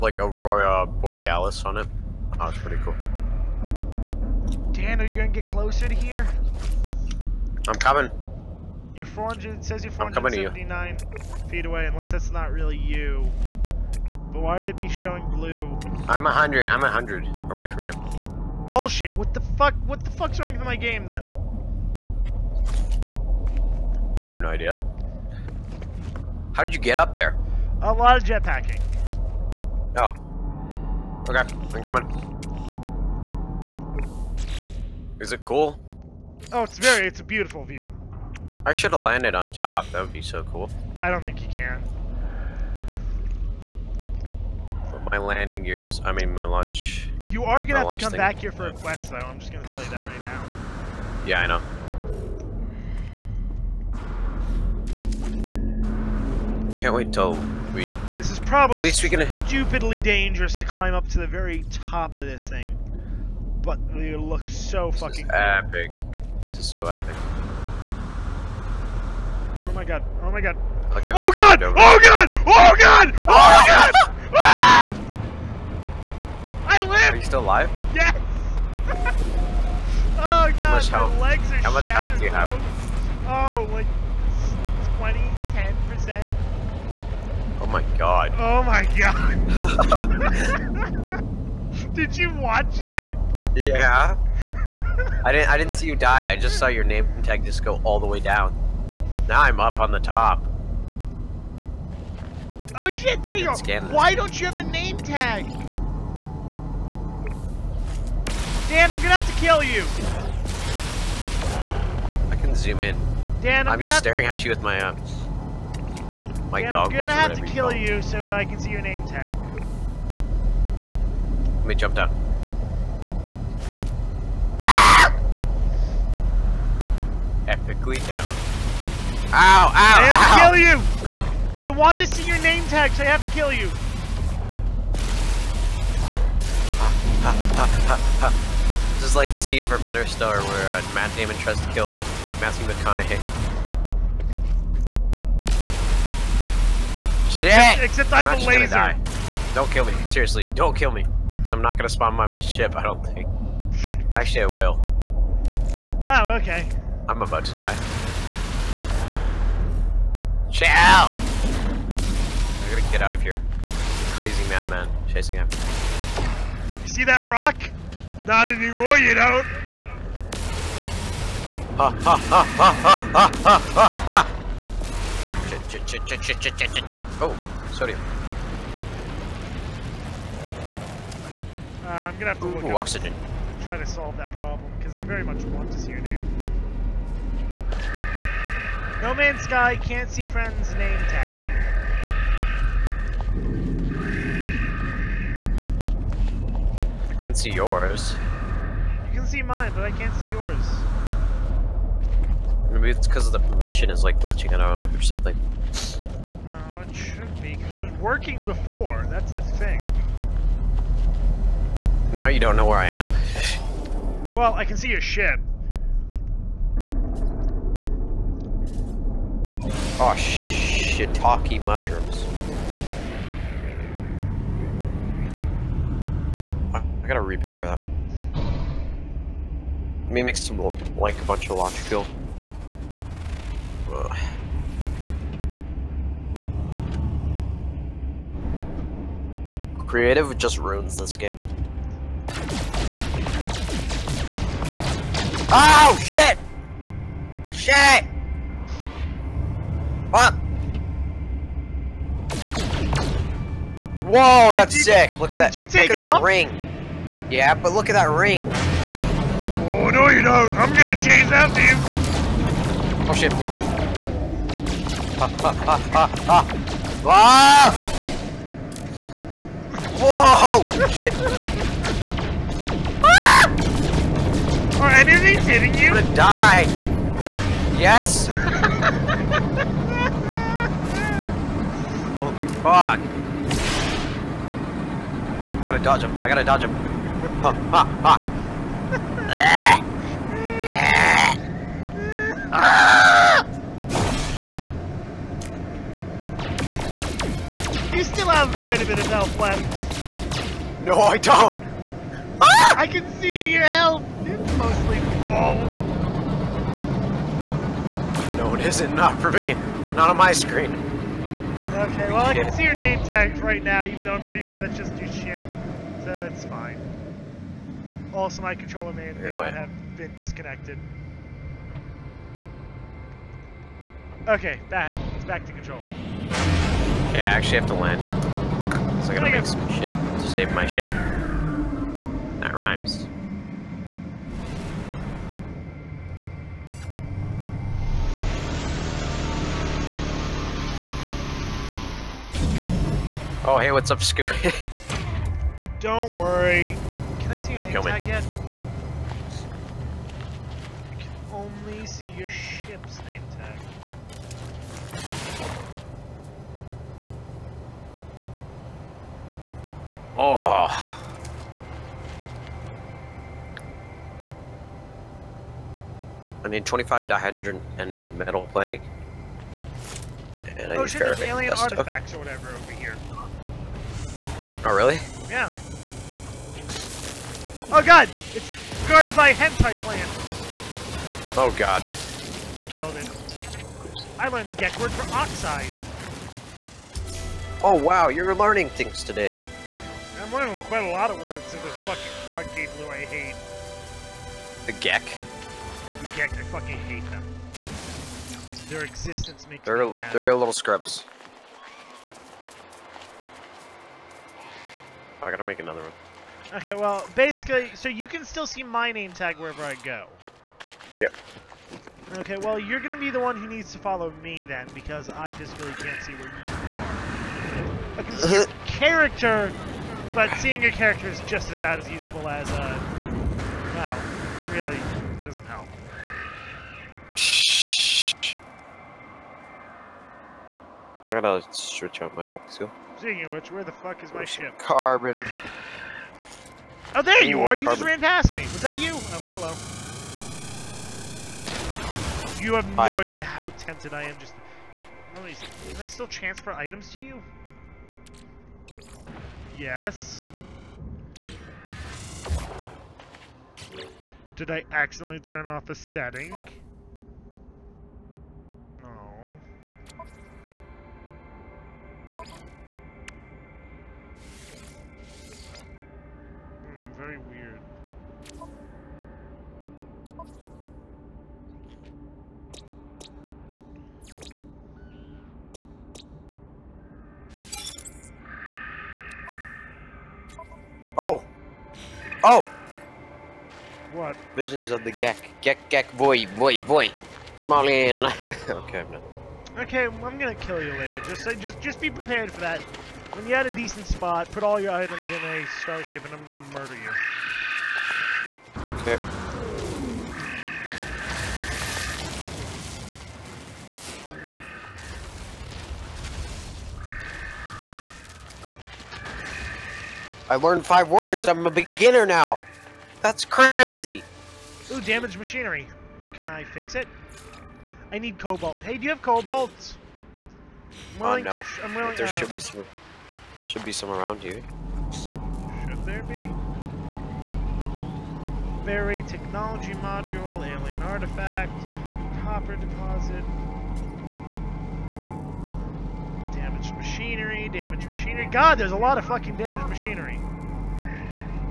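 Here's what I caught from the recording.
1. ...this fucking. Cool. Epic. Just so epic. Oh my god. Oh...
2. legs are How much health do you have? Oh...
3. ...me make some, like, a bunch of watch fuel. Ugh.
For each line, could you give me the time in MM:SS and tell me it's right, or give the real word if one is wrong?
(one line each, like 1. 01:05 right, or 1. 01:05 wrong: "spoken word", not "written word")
1. 01:04 right
2. 01:21 right
3. 03:50 wrong: "launch", not "watch".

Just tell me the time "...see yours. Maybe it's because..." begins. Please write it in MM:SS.
03:20.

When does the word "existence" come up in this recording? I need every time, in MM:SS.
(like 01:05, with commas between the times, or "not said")
06:38.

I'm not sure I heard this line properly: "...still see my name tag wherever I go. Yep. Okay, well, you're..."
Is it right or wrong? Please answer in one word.
right.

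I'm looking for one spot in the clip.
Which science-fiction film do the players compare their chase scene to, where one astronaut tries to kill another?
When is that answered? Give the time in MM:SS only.
02:19.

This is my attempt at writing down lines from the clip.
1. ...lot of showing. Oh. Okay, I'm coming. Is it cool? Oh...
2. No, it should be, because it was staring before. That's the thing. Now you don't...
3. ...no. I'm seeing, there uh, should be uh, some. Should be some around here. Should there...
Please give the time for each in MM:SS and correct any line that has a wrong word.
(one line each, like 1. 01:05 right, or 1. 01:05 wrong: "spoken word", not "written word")
1. 00:27 wrong: "jetpacking", not "showing"
2. 03:26 wrong: "working", not "staring"
3. 08:41 wrong: "willing", not "seeing".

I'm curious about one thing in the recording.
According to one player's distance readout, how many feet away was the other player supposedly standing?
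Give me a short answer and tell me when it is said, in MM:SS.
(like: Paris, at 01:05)
479, at 00:09.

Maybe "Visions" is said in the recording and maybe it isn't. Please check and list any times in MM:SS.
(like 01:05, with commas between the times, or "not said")
08:04.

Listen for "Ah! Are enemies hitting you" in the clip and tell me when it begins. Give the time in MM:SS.
04:33.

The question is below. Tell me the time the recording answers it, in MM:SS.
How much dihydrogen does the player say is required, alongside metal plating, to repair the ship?
06:06.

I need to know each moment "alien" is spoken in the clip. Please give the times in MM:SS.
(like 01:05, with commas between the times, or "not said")
06:11, 08:50.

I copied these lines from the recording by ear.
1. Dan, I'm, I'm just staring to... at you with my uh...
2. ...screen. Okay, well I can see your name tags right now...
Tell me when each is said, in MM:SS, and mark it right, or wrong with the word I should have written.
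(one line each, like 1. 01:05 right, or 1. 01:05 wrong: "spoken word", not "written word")
1. 01:53 right
2. 05:10 right.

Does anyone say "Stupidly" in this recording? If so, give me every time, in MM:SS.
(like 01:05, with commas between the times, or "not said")
00:59.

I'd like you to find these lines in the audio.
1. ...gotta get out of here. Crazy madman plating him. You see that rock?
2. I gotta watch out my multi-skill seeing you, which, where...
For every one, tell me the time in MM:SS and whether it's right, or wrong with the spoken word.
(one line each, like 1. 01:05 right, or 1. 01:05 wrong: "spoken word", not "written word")
1. 02:42 wrong: "chasing", not "plating"
2. 07:11 wrong: "switch", not "watch".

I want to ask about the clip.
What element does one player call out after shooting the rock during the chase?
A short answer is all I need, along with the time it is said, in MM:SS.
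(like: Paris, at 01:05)
Sodium, at 02:57.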